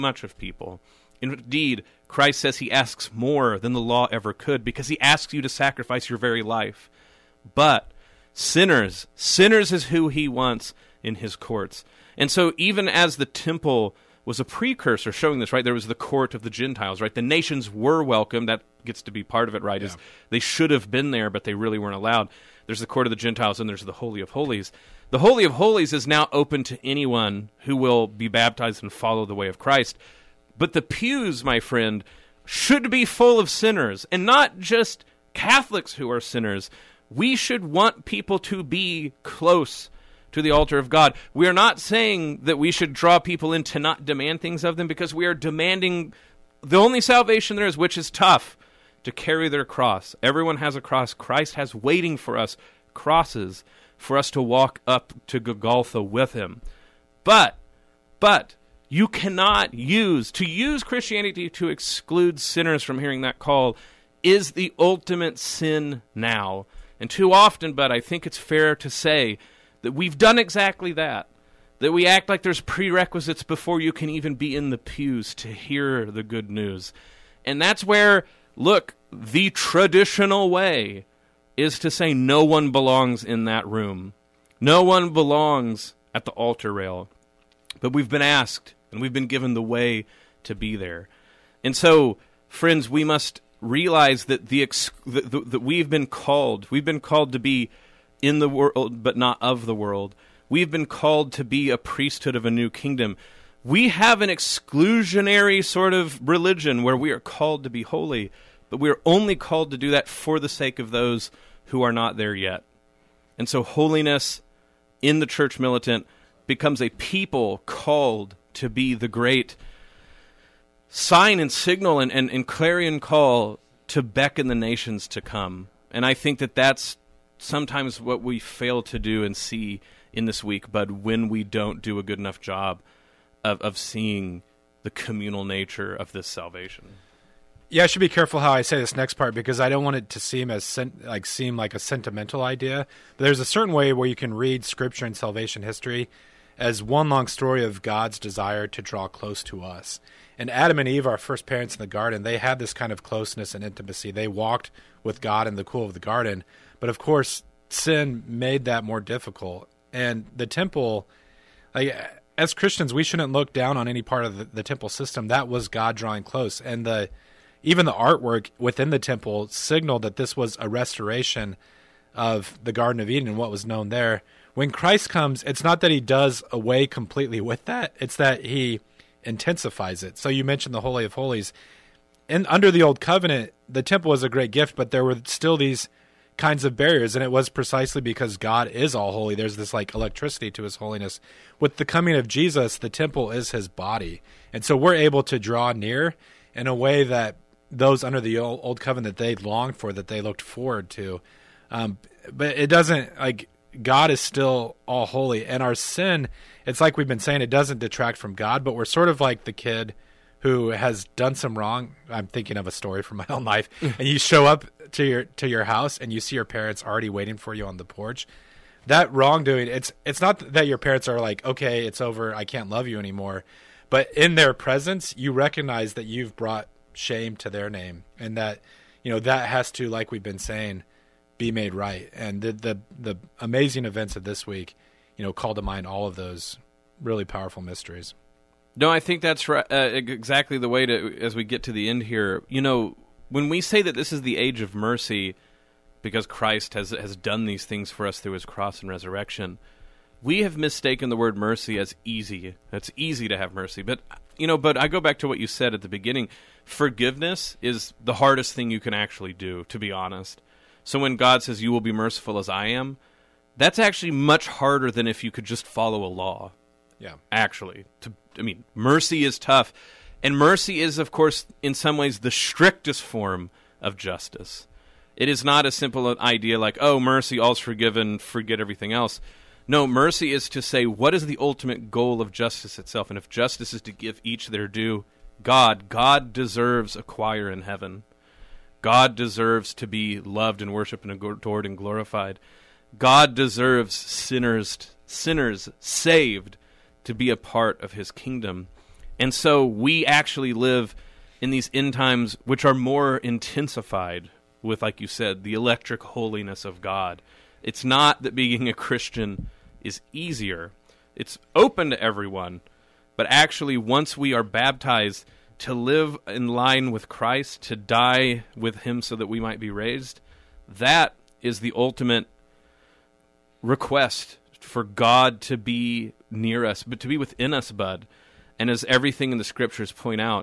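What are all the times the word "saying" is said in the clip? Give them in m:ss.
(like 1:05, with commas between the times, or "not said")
0:41, 3:27, 3:50.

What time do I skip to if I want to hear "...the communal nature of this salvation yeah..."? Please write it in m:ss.
2:14.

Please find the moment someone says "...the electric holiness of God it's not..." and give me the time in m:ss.
5:05.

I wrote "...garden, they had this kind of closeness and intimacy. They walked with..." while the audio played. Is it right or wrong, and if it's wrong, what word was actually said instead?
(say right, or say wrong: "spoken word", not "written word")
right.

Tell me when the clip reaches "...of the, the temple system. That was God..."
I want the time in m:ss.
2:44.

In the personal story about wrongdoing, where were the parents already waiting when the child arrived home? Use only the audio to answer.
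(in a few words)
on the porch.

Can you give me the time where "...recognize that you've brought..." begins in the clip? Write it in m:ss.
3:45.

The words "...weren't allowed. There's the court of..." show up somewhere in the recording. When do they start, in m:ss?
0:21.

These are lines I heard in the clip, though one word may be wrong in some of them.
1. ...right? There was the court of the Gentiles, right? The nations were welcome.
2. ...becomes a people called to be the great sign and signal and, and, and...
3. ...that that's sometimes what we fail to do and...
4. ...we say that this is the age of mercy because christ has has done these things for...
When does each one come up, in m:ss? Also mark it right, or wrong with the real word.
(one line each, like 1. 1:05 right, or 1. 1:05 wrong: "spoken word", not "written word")
1. 0:15 right
2. 1:56 right
3. 2:06 right
4. 4:03 right.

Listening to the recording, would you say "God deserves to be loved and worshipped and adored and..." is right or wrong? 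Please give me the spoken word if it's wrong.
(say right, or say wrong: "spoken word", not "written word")
right.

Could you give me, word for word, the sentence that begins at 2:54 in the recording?
When Christ comes, it's not that he does away completely with that, it's that he intensifies it.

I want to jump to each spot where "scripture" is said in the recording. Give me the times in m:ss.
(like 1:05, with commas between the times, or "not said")
2:24, 5:29.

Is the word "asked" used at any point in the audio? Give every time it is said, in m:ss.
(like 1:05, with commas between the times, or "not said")
1:28.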